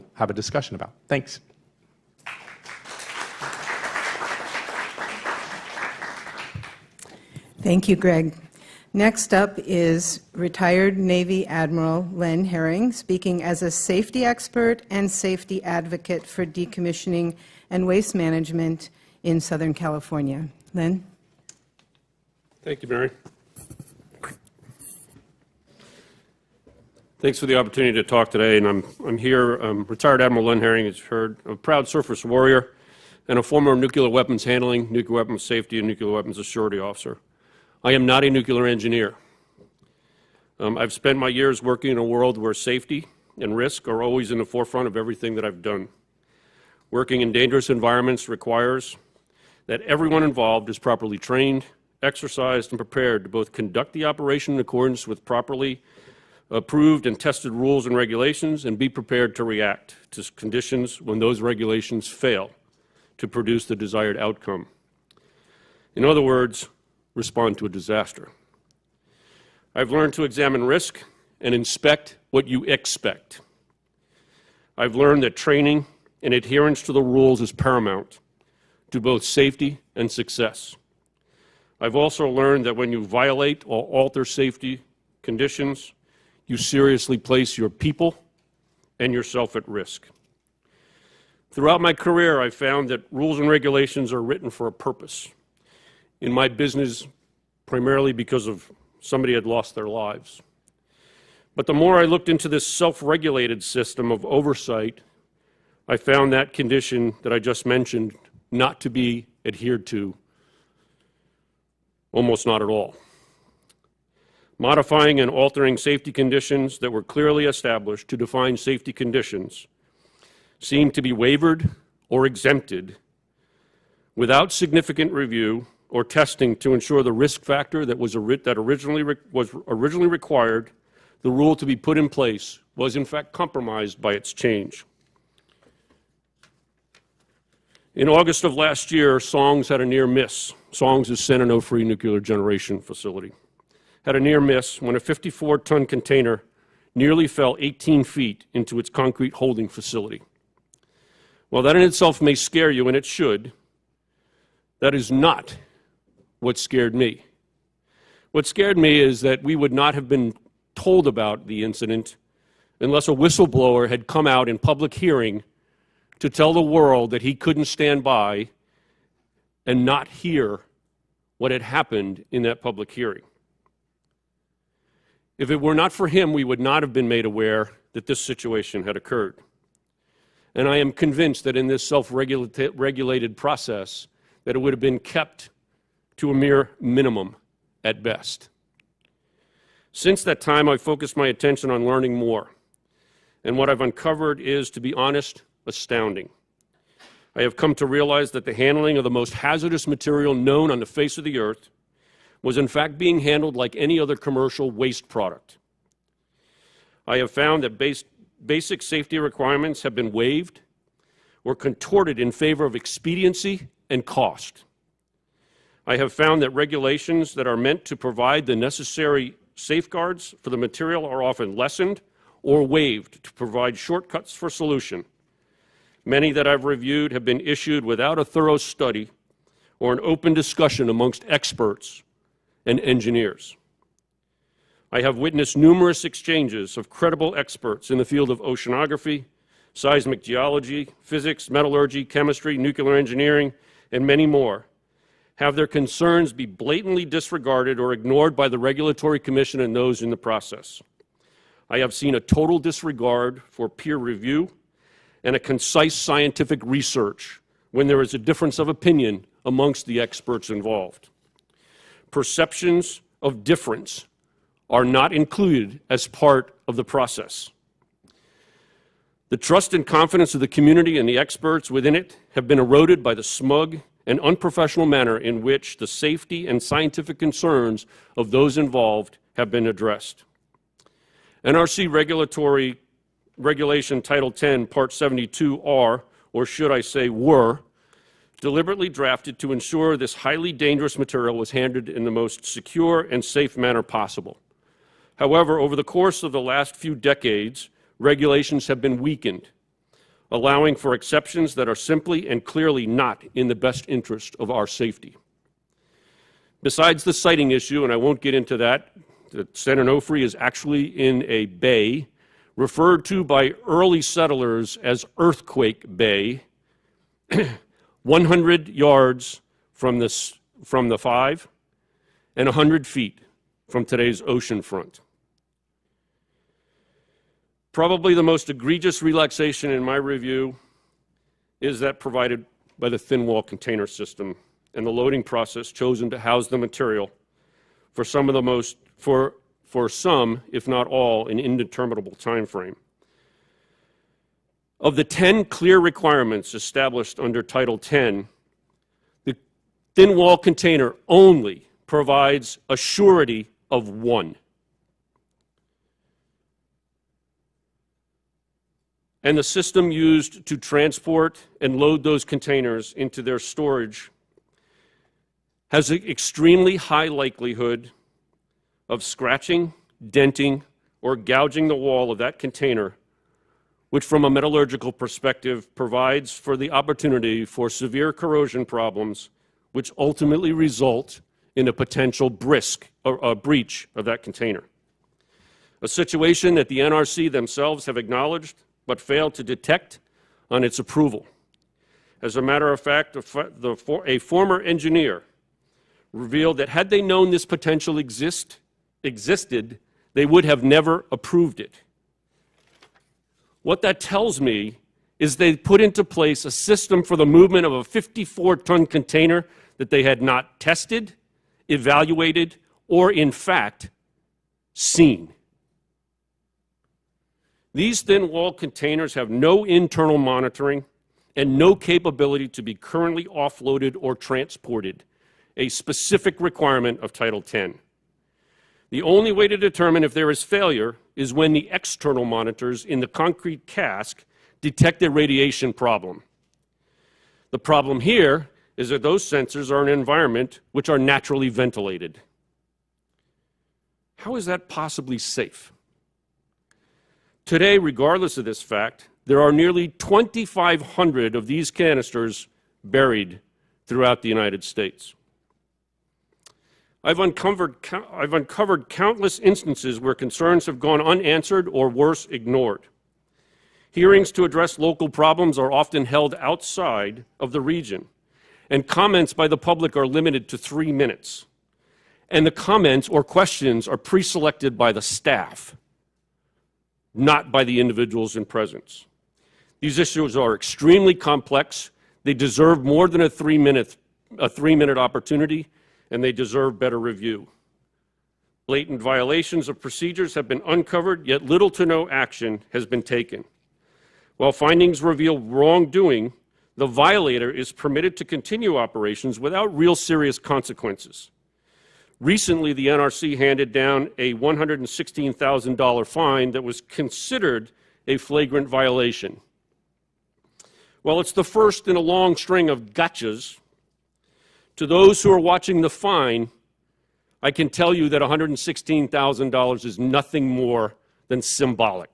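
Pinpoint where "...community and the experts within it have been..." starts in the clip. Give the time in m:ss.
4:30.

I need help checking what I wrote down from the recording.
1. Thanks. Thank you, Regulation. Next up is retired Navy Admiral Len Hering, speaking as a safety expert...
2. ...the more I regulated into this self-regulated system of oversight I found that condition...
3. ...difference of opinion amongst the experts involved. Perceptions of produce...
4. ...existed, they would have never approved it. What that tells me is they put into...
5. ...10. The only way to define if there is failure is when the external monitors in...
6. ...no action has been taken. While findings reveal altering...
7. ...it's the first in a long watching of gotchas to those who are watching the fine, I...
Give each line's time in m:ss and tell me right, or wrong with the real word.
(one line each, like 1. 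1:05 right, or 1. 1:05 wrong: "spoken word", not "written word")
1. 0:01 wrong: "Greg", not "Regulation"
2. 1:41 wrong: "looked", not "regulated"
3. 4:18 wrong: "difference", not "produce"
4. 6:39 right
5. 7:07 wrong: "determine", not "define"
6. 8:11 wrong: "wrongdoing", not "altering"
7. 8:31 wrong: "string", not "watching".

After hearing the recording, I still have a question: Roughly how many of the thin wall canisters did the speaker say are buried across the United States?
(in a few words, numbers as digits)
2,500.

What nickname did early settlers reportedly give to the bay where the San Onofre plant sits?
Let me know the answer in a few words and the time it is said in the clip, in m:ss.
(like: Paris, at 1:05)
Earthquake Bay, at 5:15.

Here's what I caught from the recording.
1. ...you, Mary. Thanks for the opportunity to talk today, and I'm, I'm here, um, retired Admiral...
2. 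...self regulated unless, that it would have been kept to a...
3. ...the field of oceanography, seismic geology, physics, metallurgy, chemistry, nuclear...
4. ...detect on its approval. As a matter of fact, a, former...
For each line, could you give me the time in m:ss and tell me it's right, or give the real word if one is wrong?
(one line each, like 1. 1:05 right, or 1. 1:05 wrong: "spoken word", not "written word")
1. 0:22 right
2. 3:01 wrong: "process", not "unless"
3. 3:57 right
4. 6:29 right.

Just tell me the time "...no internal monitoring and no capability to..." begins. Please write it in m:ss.
6:59.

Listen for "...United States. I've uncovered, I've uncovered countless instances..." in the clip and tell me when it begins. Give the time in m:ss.
7:34.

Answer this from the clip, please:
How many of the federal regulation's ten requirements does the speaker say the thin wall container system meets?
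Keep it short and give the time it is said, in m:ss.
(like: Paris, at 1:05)
1, at 5:53.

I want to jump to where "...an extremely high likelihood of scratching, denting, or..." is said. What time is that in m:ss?
6:05.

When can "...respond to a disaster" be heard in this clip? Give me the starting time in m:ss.
1:07.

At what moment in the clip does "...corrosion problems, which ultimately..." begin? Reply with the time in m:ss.
6:18.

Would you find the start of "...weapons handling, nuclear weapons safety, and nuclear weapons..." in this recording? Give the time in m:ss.
0:34.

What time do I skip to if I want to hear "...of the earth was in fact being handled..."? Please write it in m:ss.
3:21.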